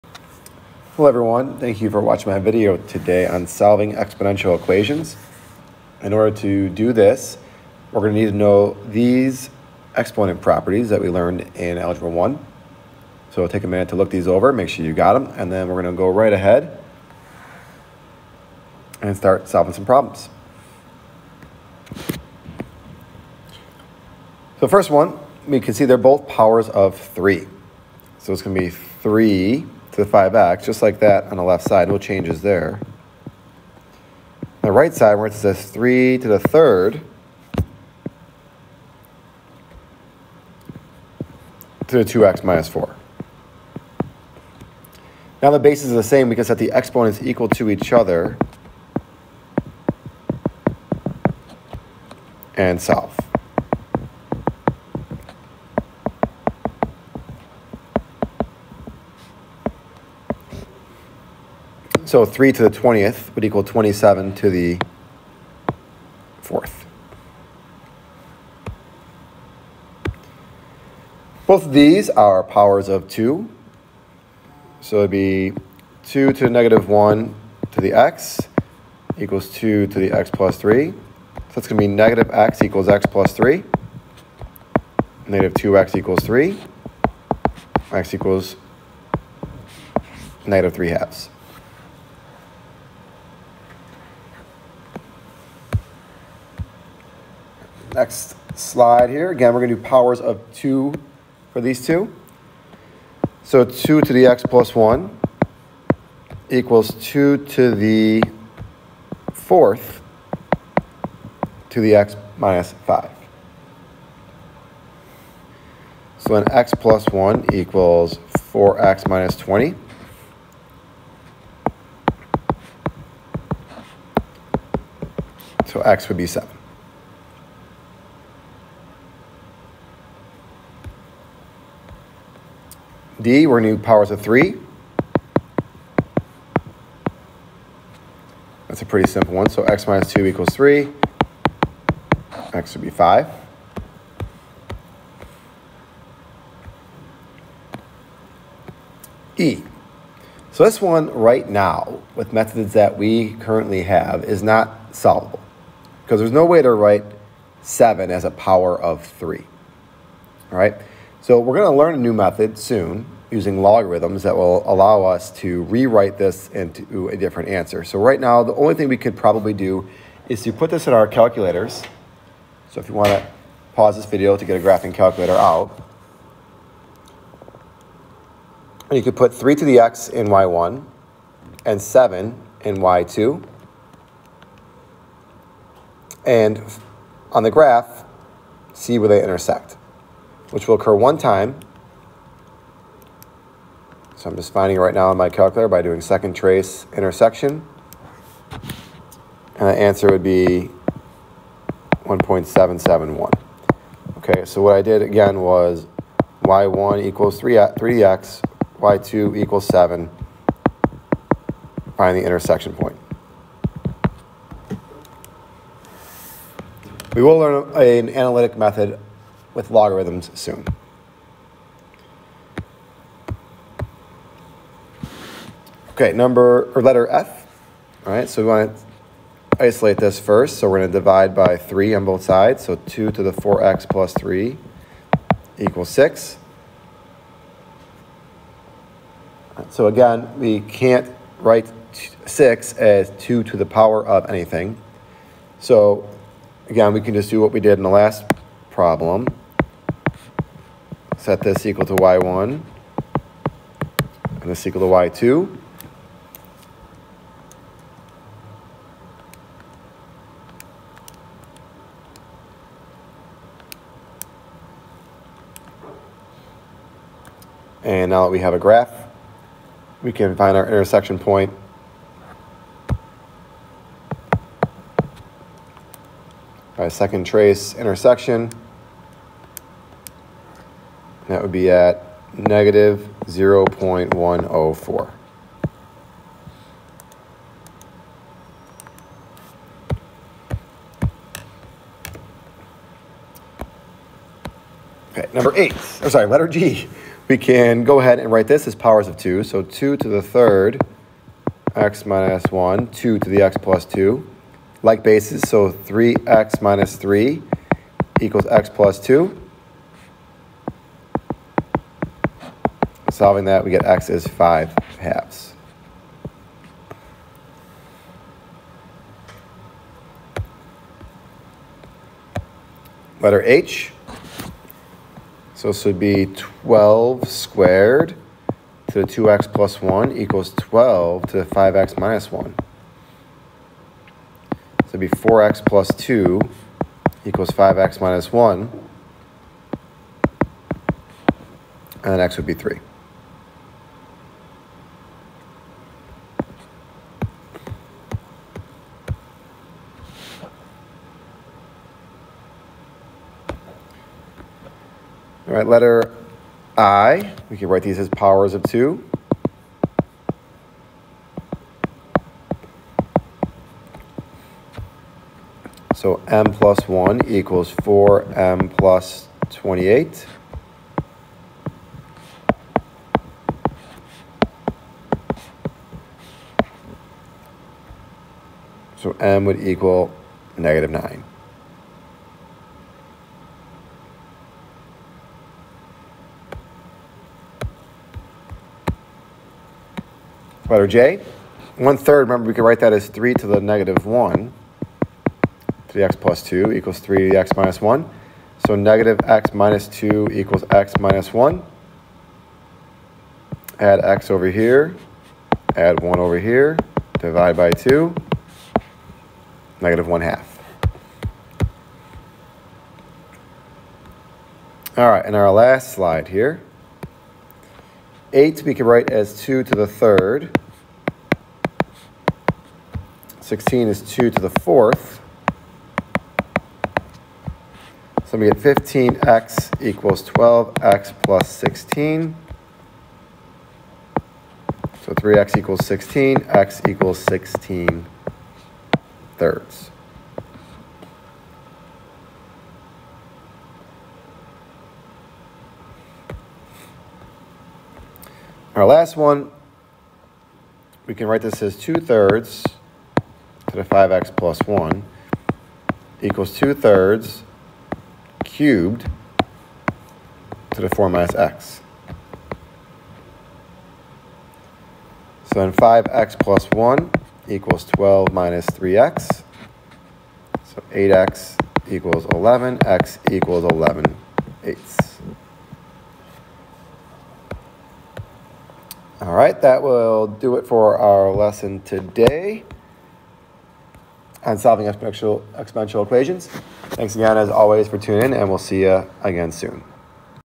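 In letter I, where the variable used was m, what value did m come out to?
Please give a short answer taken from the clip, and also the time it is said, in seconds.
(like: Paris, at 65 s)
-9, at 380 s.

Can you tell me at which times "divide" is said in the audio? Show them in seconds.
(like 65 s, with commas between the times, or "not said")
230 s, 407 s.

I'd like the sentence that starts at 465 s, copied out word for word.
So then 5x plus 1 equals 12 minus 3x.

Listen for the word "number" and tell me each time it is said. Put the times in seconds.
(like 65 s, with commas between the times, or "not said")
226 s, 295 s.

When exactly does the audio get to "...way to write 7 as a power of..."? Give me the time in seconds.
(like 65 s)
156 s.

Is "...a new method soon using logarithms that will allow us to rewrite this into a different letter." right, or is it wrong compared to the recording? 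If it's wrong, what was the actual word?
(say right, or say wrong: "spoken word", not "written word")
wrong: "answer", not "letter".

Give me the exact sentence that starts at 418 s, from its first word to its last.
8 we could write as 2 to the third 16 is 2 to the 4th.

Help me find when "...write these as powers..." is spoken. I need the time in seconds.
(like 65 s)
357 s.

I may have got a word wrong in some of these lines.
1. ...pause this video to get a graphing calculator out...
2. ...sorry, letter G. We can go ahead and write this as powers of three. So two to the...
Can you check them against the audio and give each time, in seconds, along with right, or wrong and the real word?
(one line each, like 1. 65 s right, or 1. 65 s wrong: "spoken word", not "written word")
1. 173 s right
2. 296 s wrong: "two", not "three".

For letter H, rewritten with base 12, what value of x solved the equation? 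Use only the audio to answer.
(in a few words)
3.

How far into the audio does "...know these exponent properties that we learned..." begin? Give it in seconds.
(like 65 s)
8 s.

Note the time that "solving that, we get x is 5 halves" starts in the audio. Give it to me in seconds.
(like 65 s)
313 s.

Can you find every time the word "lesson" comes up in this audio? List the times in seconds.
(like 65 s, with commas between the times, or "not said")
481 s.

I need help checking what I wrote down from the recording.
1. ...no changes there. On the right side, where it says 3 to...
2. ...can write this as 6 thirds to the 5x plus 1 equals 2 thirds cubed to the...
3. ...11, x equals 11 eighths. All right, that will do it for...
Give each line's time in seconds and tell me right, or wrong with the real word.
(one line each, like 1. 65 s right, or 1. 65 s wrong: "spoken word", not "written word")
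1. 31 s right
2. 451 s wrong: "2", not "6"
3. 472 s right.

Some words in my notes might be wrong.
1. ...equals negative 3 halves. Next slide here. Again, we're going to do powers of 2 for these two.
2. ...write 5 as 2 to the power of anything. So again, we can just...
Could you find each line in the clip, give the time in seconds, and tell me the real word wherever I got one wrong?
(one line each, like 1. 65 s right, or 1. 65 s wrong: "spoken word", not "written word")
1. 88 s right
2. 241 s wrong: "6", not "5".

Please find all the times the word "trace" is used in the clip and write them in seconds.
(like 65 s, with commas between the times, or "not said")
196 s, 277 s.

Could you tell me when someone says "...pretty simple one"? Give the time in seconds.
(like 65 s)
138 s.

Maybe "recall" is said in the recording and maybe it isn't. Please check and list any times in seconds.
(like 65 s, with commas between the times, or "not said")
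not said.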